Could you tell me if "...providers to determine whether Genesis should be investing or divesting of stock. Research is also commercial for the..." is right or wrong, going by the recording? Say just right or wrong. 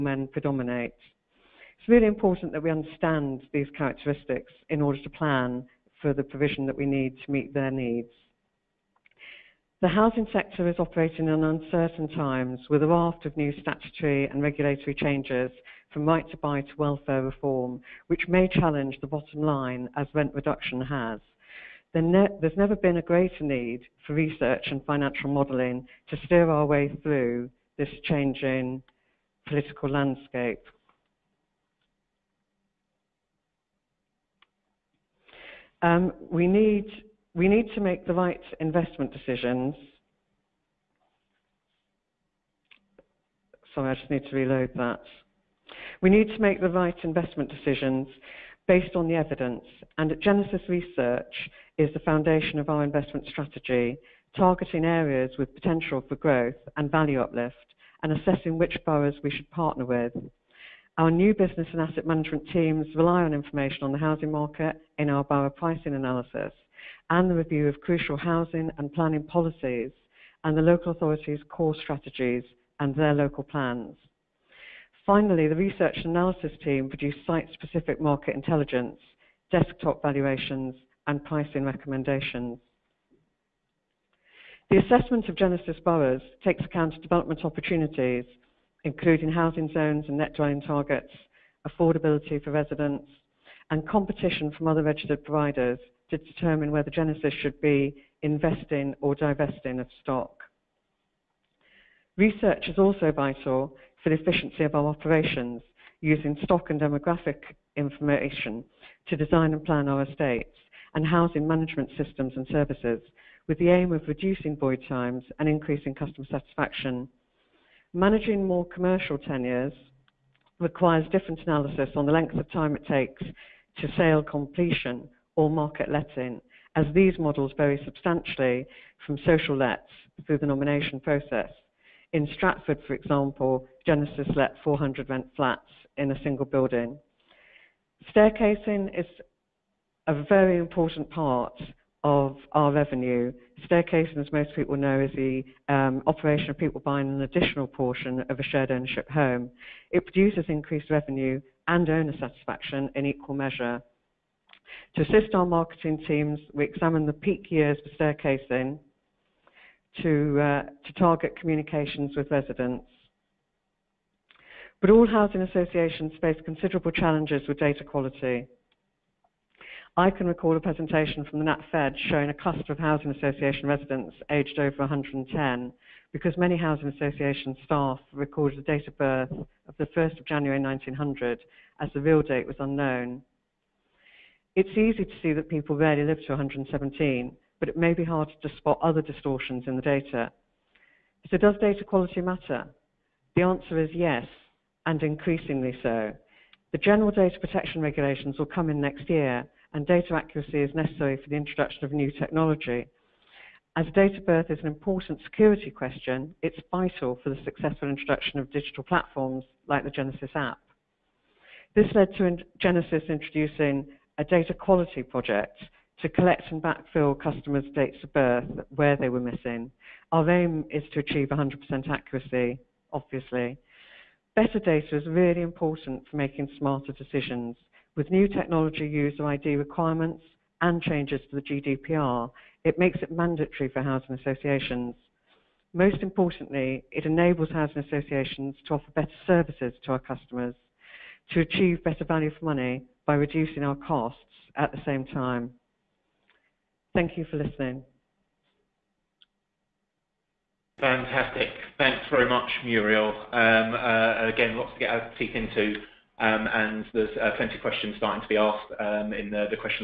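wrong.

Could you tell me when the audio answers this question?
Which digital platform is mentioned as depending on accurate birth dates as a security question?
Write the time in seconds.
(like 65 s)
209 s.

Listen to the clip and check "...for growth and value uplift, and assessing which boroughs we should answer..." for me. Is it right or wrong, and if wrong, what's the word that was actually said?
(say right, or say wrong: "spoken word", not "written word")
wrong: "partner", not "answer".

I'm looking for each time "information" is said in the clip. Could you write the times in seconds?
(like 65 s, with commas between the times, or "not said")
63 s, 107 s.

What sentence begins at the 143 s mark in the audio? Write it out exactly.
Staircasing, as most people know, is the um, operation of people buying an additional portion of a shared ownership home.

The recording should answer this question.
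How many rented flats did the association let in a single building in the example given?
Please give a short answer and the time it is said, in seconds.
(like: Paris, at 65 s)
400, at 134 s.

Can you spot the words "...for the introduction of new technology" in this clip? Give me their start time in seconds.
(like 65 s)
201 s.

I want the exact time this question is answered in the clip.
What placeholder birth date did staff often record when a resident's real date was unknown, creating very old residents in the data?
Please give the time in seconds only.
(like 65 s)
179 s.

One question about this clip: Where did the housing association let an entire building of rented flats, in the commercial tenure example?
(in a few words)
Stratford.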